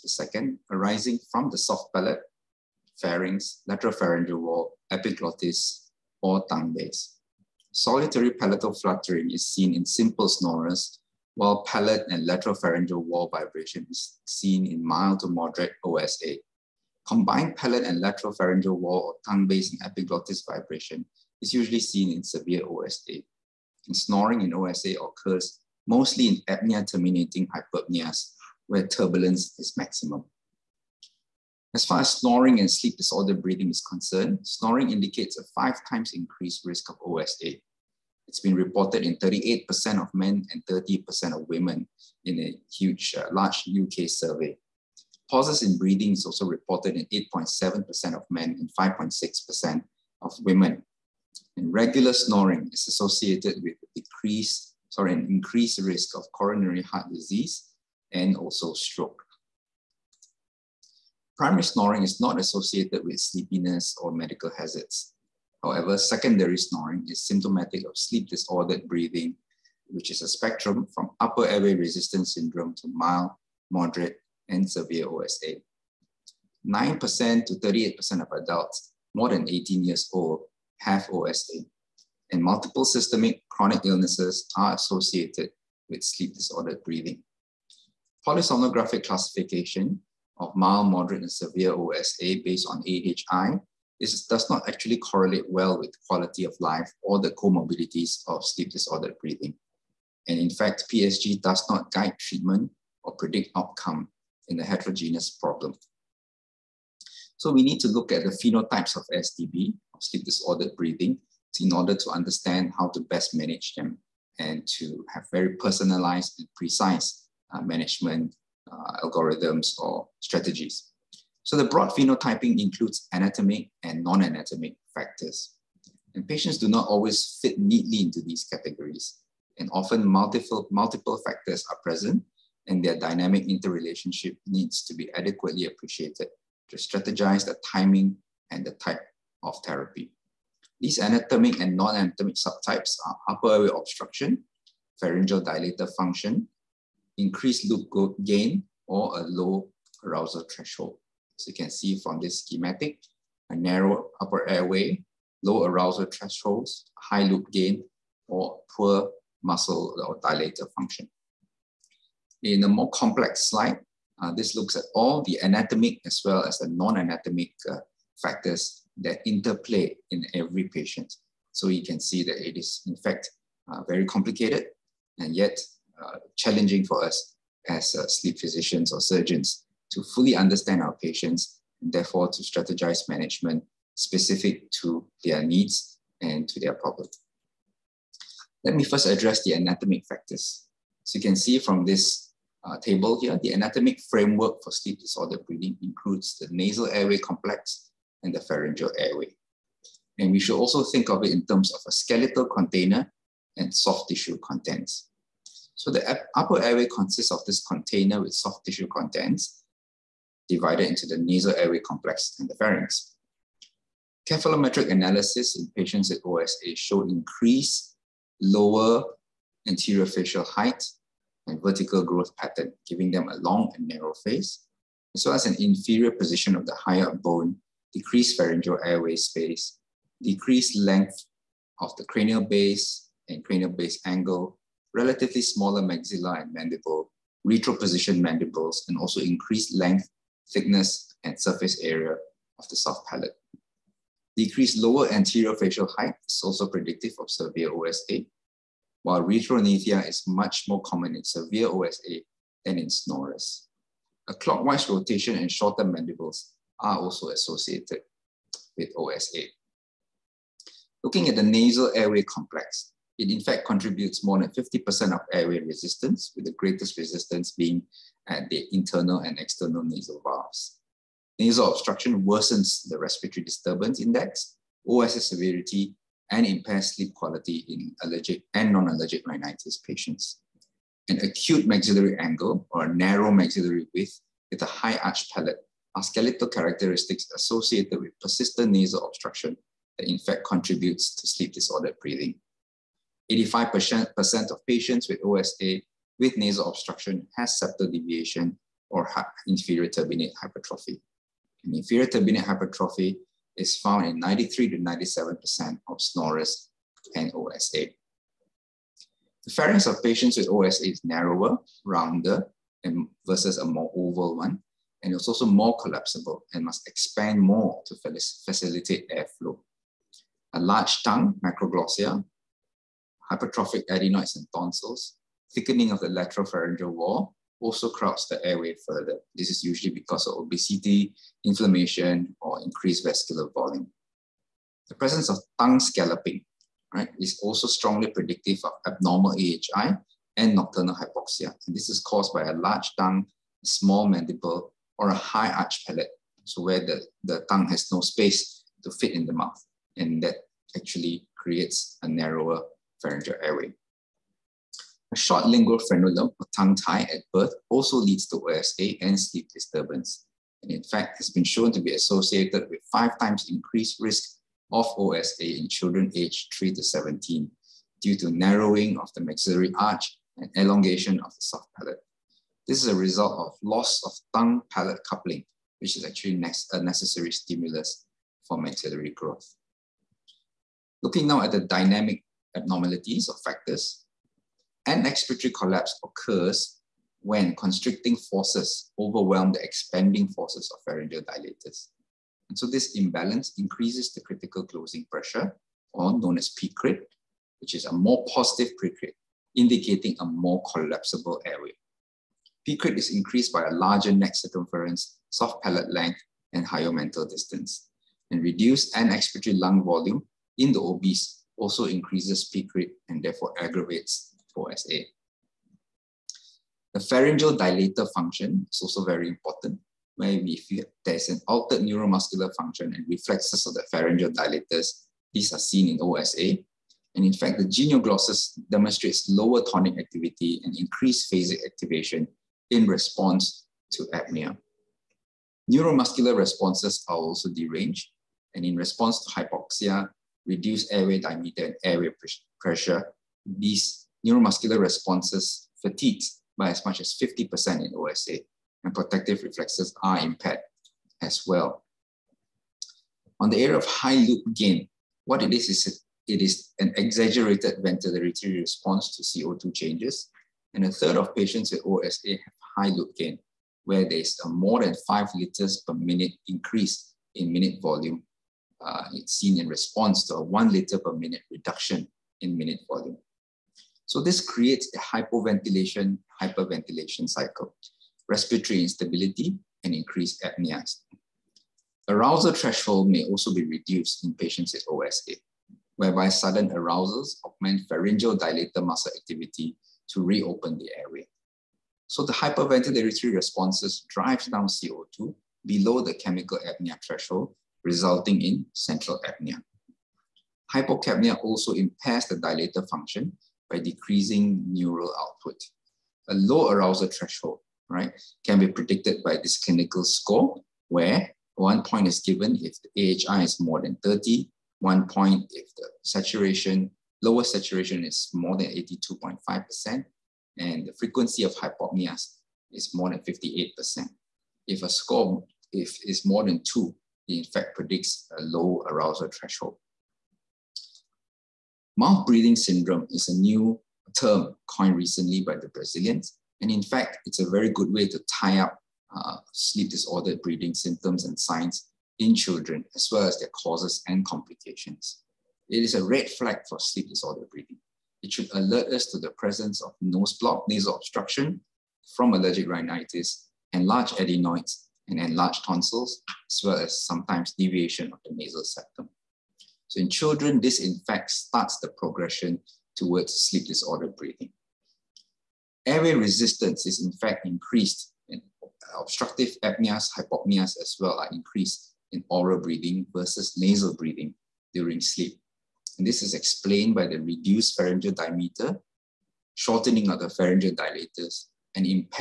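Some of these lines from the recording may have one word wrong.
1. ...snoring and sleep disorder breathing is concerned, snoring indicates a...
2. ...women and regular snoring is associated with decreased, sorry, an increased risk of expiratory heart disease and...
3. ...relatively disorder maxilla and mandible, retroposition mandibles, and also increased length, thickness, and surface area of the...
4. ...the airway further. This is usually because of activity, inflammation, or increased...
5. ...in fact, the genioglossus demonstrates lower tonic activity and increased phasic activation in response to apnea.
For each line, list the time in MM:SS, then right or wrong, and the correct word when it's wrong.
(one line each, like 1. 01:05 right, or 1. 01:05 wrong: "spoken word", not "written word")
1. 00:32 right
2. 00:50 wrong: "coronary", not "expiratory"
3. 03:54 wrong: "smaller", not "disorder"
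4. 05:28 wrong: "obesity", not "activity"
5. 07:07 right.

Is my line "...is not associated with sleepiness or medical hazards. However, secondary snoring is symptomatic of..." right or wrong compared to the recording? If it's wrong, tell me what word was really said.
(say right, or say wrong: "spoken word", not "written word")
right.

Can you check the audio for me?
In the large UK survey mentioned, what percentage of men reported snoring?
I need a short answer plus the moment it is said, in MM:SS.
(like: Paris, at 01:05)
38%, at 00:39.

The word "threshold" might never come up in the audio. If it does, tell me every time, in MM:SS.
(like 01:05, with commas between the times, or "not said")
02:30, 02:36, 08:02, 08:17, 08:27, 08:49.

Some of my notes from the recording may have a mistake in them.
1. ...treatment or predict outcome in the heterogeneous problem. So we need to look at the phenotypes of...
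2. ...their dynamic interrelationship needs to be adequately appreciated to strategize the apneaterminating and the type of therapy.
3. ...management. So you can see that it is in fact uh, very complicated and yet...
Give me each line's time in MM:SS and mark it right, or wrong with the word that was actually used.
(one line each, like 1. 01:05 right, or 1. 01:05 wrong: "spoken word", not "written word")
1. 01:42 right
2. 02:12 wrong: "timing", not "apneaterminating"
3. 02:50 wrong: "patient", not "management".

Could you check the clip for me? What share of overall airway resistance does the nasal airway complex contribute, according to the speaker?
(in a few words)
More than 50%.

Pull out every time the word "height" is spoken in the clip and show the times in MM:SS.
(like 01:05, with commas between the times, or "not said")
03:40, 04:05.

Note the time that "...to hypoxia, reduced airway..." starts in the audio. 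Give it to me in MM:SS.
07:19.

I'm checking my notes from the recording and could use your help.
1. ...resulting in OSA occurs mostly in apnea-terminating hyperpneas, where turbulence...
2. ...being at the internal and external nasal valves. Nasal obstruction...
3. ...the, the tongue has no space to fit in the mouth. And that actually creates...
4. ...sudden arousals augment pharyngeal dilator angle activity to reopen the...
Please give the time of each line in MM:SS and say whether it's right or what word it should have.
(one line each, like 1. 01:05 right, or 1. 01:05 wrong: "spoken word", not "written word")
1. 00:23 wrong: "snoring", not "resulting"
2. 04:27 right
3. 05:46 right
4. 08:06 wrong: "muscle", not "angle".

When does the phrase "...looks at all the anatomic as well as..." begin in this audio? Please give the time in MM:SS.
02:44.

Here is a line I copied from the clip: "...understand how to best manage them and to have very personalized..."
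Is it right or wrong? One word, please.
right.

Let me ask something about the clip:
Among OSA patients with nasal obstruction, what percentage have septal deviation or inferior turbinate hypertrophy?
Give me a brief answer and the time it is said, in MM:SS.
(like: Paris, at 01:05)
85%, at 04:53.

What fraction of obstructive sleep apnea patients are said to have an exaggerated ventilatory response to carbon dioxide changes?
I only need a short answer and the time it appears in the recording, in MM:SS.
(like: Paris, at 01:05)
A third, at 07:40.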